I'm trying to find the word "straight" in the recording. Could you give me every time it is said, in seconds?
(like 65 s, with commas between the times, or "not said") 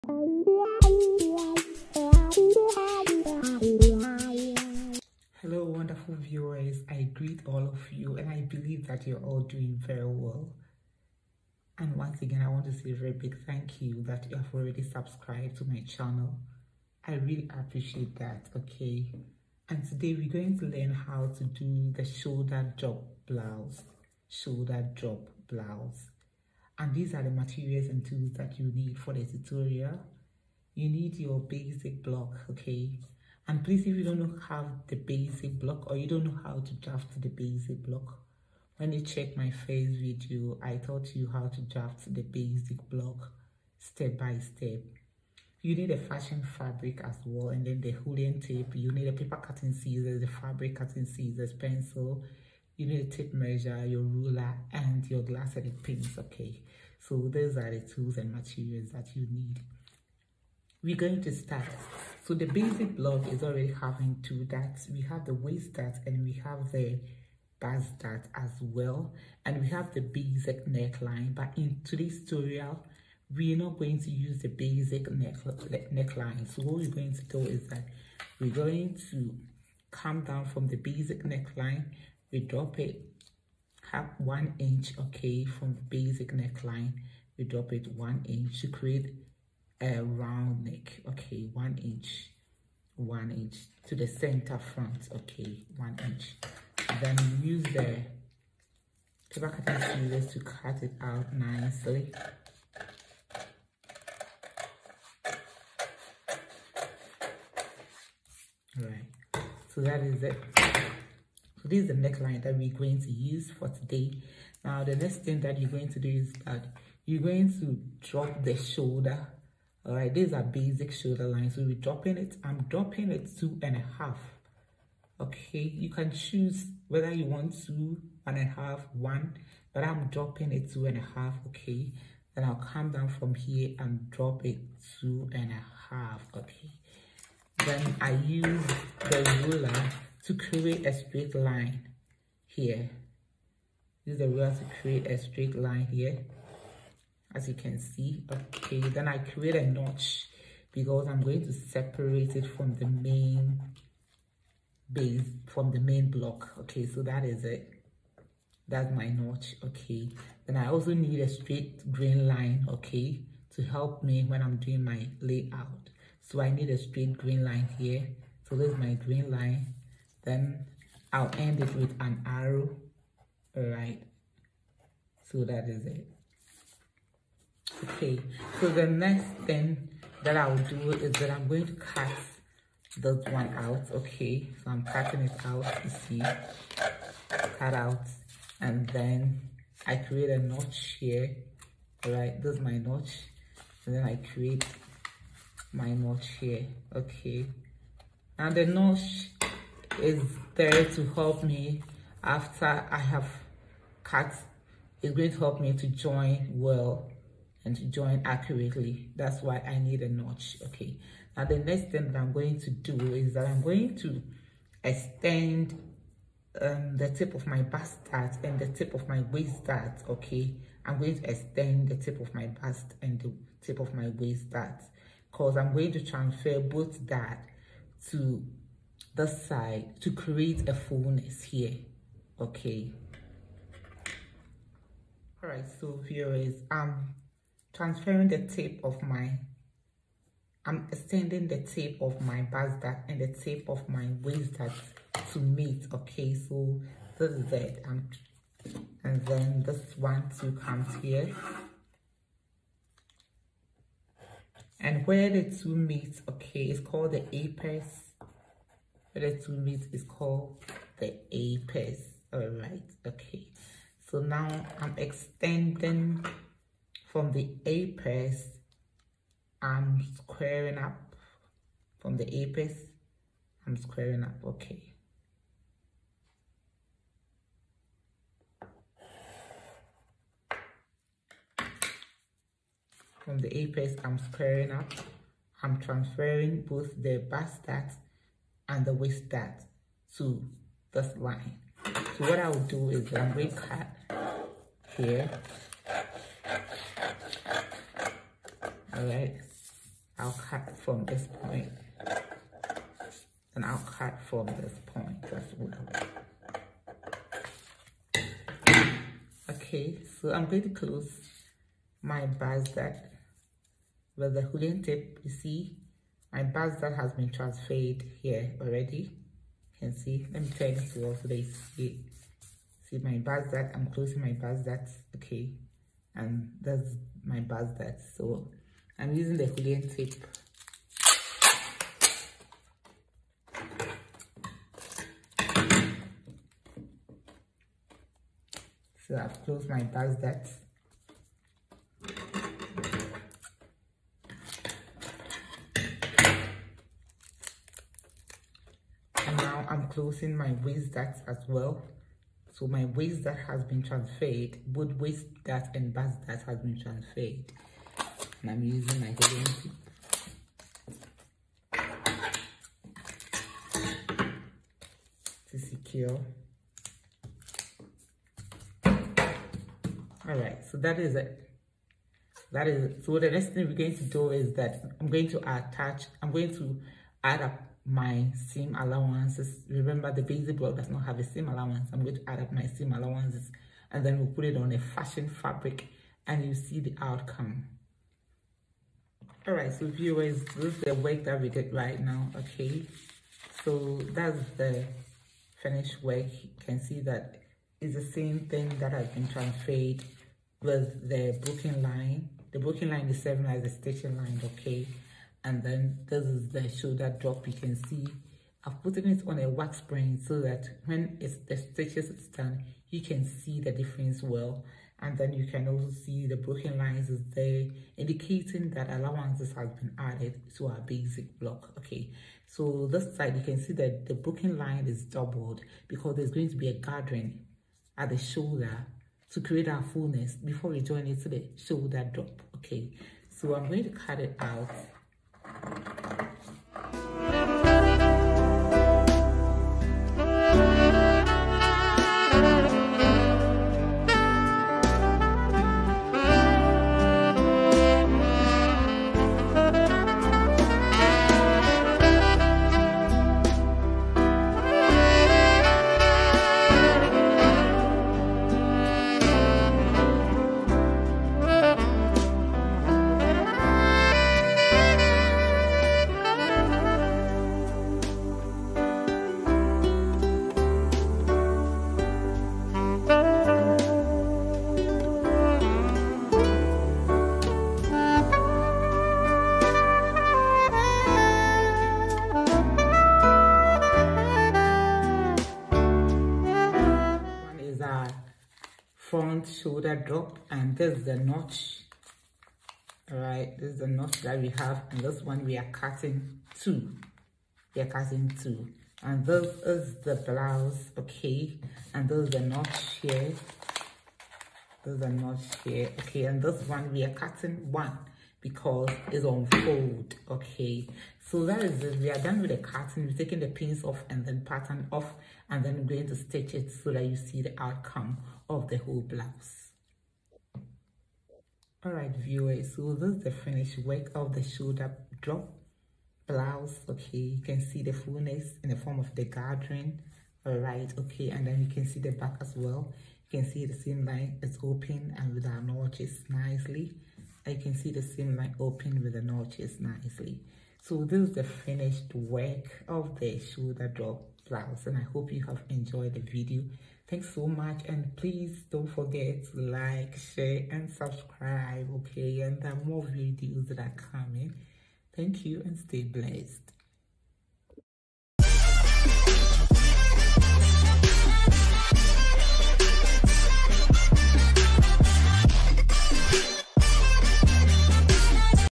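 140 s, 145 s, 161 s, 166 s.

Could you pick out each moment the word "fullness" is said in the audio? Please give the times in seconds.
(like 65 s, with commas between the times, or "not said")
230 s, 429 s, 527 s.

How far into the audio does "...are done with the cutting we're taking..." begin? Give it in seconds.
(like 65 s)
512 s.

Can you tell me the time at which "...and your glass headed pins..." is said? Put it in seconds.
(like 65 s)
54 s.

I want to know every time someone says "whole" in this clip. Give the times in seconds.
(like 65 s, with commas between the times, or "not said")
518 s.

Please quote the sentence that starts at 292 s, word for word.
So what I will do is I'm going to cut here.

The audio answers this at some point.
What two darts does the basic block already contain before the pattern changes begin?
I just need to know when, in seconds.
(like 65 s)
65 s.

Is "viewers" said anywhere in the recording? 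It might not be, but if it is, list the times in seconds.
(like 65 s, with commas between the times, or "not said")
6 s, 236 s, 389 s, 522 s.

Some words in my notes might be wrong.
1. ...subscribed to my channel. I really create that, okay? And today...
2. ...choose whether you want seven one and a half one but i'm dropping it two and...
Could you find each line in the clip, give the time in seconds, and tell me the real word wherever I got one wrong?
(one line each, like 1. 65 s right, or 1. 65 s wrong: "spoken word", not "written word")
1. 14 s wrong: "appreciate", not "create"
2. 126 s wrong: "two", not "seven".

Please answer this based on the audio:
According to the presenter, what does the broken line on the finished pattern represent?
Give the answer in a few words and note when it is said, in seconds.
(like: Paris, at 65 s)
stitching line, at 403 s.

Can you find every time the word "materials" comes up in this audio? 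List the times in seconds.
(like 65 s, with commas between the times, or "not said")
27 s, 58 s.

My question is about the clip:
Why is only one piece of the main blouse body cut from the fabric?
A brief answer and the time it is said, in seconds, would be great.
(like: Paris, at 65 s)
it's on fold, at 508 s.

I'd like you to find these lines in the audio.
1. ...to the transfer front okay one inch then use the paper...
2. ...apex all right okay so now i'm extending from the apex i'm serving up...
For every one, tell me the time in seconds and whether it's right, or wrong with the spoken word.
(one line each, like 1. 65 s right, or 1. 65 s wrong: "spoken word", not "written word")
1. 93 s wrong: "center", not "transfer"
2. 261 s wrong: "squaring", not "serving".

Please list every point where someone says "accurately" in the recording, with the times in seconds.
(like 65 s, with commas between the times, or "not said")
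208 s.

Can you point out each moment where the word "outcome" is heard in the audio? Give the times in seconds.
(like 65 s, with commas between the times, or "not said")
387 s, 517 s.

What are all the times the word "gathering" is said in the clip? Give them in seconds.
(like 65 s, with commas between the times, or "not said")
426 s, 529 s.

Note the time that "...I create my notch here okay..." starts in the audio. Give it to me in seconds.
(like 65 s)
194 s.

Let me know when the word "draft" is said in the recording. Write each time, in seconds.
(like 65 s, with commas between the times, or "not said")
36 s, 41 s.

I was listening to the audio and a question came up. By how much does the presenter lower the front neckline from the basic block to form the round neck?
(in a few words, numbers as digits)
1 inch.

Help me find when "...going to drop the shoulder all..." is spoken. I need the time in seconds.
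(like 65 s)
117 s.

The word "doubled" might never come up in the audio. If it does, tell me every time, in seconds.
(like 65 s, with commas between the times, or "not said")
425 s.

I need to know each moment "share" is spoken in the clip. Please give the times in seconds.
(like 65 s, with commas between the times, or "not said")
550 s.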